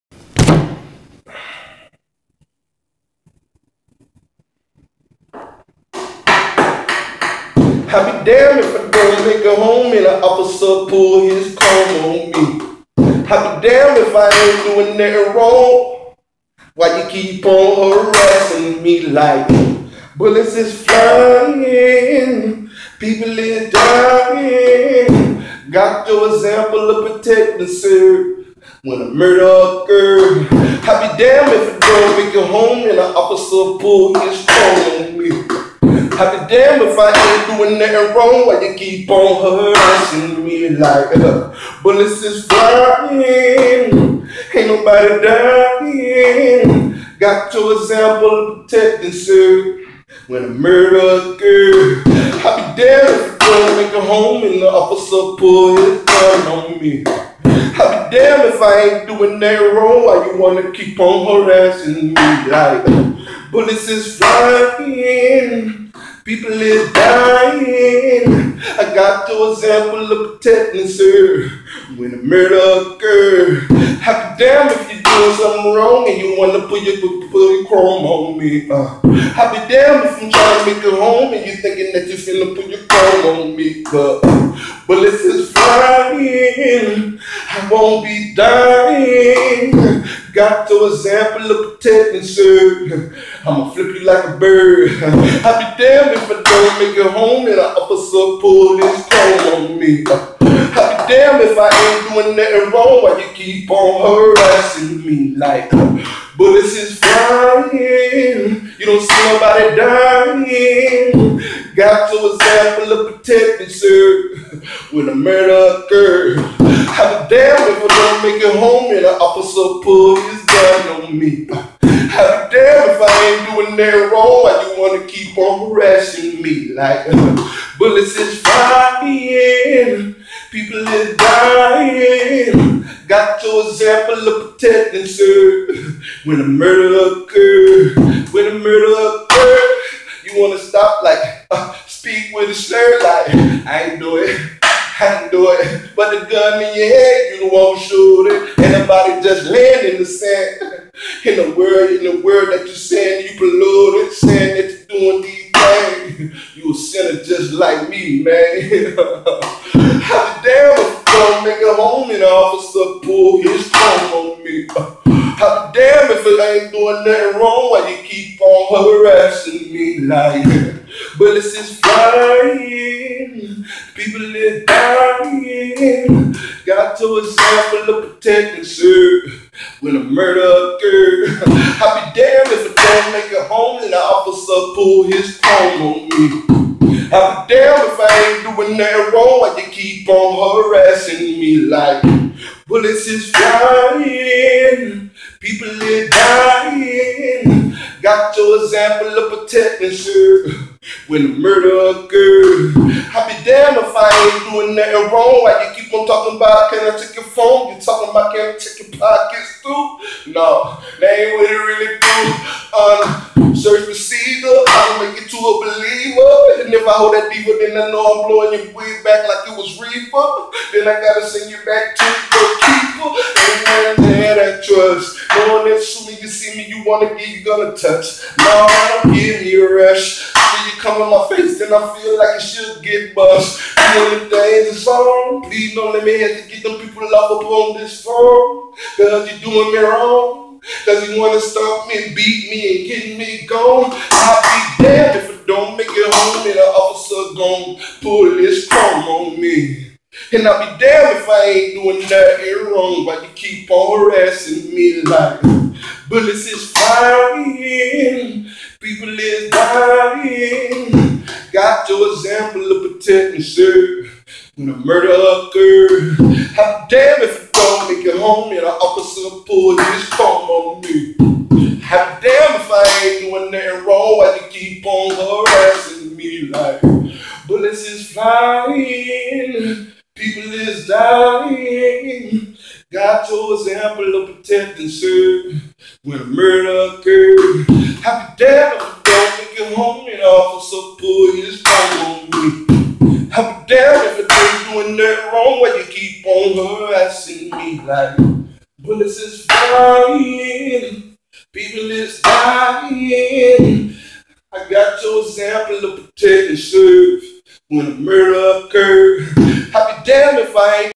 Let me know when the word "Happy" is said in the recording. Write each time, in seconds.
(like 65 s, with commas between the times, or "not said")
288 s, 293 s.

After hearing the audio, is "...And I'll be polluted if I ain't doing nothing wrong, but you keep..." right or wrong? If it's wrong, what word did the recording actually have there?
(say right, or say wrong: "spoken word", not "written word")
wrong: "damned", not "polluted".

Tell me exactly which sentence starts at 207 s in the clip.
You talking about can I check your pockets too?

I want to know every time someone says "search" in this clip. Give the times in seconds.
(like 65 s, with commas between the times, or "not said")
213 s.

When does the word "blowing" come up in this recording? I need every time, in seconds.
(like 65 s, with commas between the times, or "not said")
218 s.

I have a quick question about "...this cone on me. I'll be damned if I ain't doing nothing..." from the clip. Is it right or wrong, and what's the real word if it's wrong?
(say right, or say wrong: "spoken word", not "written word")
right.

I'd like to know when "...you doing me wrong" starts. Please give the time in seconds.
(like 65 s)
239 s.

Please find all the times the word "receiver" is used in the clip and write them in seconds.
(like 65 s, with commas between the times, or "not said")
213 s.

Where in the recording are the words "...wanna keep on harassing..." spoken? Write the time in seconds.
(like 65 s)
60 s.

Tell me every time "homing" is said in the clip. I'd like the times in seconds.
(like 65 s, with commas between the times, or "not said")
161 s.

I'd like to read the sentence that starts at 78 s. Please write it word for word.
Uh, i be damned if I'm trying to make it home and you thinking that you're finna put your chrome on me.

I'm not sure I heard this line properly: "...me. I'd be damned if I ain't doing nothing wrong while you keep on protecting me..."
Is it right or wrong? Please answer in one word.
wrong.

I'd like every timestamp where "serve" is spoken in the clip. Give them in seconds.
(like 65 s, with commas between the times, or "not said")
284 s, 306 s.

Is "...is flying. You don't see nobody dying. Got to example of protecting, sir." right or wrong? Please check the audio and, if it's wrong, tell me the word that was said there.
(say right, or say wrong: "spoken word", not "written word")
right.